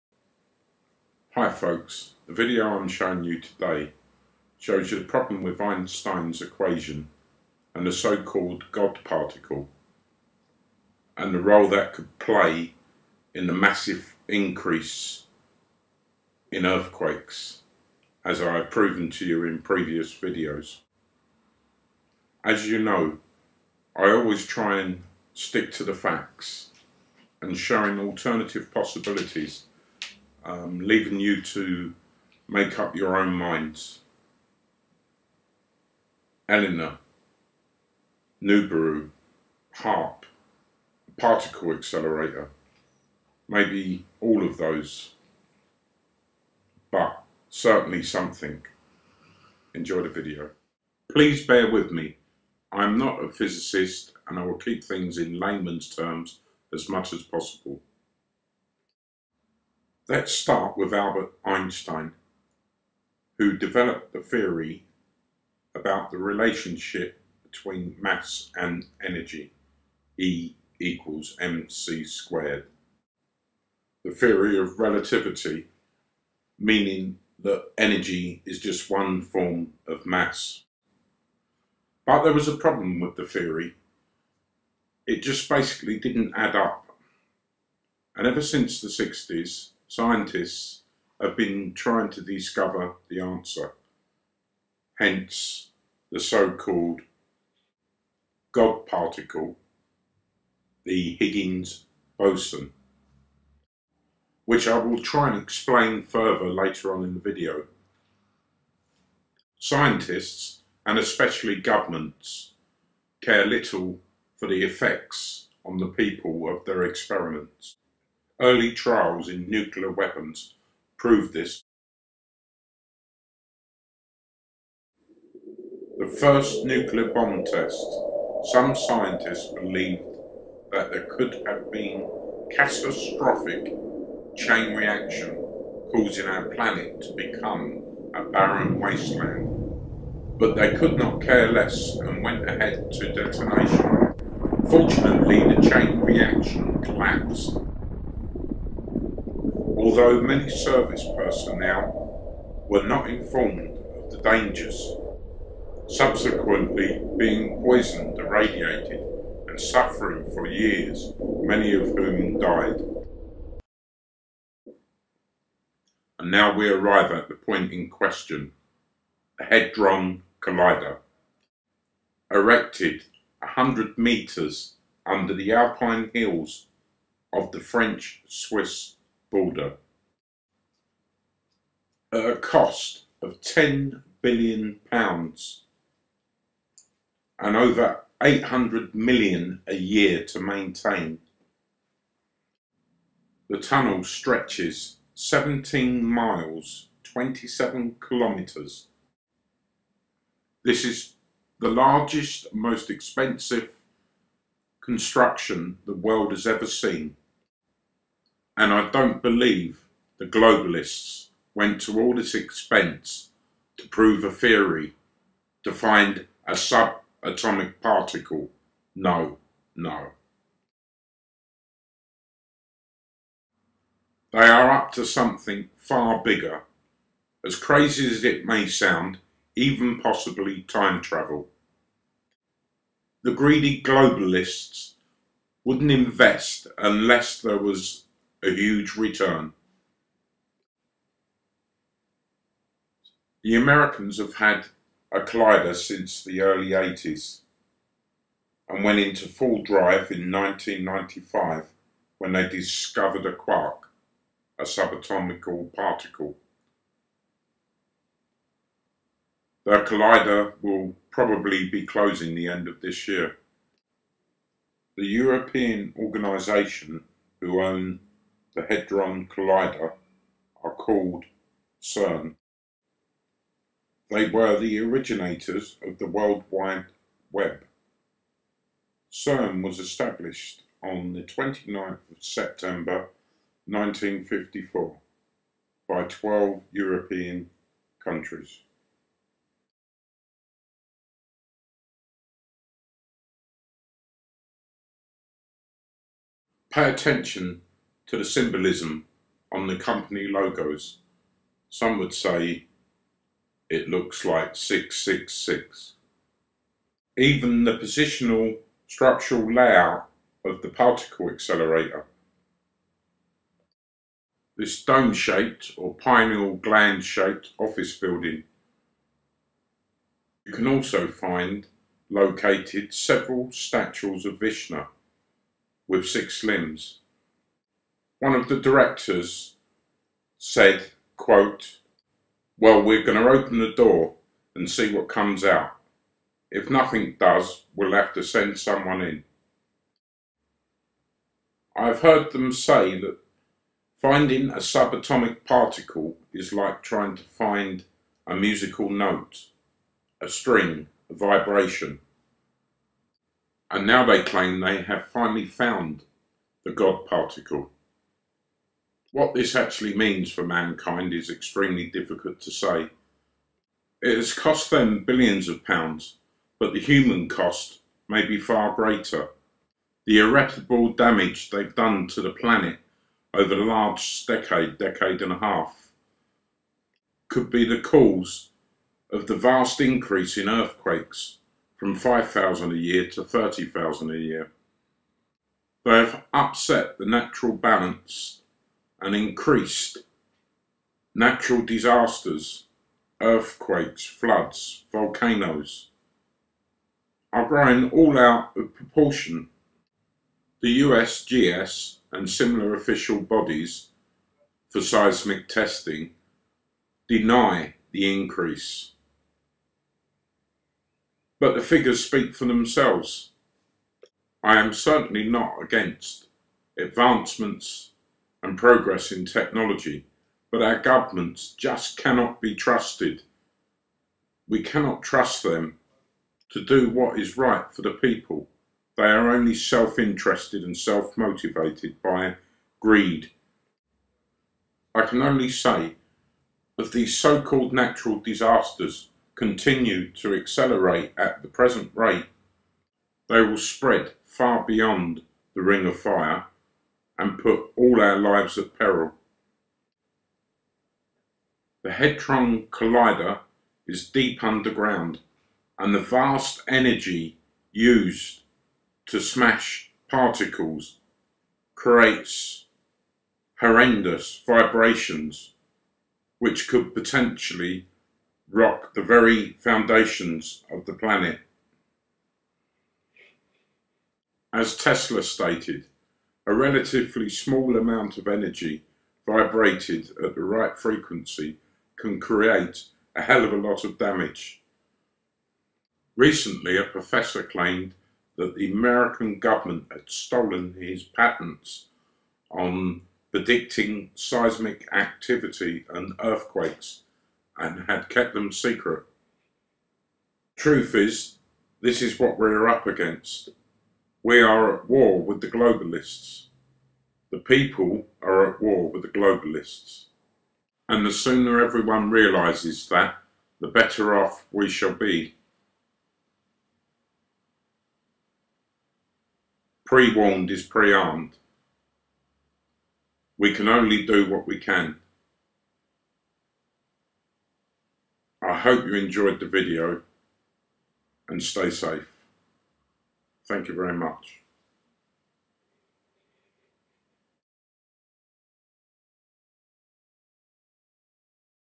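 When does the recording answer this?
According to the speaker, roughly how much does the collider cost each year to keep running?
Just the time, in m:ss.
3:08.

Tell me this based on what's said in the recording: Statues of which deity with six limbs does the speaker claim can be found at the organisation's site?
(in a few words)
Vishnu.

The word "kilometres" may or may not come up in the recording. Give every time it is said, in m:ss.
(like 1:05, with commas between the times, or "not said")
3:18.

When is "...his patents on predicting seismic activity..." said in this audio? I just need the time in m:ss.
8:10.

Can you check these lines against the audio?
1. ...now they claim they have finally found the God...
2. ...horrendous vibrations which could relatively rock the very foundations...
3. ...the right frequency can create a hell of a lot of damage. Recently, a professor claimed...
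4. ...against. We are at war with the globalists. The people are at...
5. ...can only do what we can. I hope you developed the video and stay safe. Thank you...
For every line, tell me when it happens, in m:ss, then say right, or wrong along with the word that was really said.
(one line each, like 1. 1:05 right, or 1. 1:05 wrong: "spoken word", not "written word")
1. 5:53 right
2. 7:43 wrong: "potentially", not "relatively"
3. 8:00 right
4. 8:22 right
5. 8:43 wrong: "enjoyed", not "developed".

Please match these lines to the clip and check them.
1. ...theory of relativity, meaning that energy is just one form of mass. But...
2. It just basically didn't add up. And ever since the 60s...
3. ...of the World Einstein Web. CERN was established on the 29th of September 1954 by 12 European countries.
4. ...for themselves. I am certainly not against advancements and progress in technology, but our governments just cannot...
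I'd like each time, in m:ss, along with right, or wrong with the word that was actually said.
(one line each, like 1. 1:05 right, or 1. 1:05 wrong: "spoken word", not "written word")
1. 1:14 right
2. 1:25 right
3. 4:35 wrong: "Wide", not "Einstein"
4. 6:52 right.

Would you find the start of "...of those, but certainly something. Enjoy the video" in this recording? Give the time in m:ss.
0:44.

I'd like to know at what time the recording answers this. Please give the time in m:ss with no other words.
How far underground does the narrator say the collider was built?
2:53.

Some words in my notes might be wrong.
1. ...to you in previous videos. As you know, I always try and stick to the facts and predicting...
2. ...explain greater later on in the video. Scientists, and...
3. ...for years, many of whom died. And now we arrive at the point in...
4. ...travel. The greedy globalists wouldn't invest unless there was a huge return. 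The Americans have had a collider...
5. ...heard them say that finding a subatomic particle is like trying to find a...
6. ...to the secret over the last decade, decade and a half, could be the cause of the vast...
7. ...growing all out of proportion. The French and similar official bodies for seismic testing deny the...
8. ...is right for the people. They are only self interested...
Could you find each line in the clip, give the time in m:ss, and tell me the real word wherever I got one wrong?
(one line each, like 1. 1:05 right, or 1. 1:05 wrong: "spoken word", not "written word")
1. 0:19 wrong: "showing", not "predicting"
2. 1:45 wrong: "further", not "greater"
3. 2:40 right
4. 3:51 right
5. 5:42 right
6. 6:12 wrong: "planet", not "secret"
7. 6:37 wrong: "USGS", not "French"
8. 7:07 right.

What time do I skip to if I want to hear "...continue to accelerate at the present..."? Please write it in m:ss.
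7:19.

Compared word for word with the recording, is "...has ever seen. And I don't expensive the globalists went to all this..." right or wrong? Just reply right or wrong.
wrong.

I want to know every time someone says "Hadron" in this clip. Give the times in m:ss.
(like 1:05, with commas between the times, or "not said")
2:49, 4:28, 7:31.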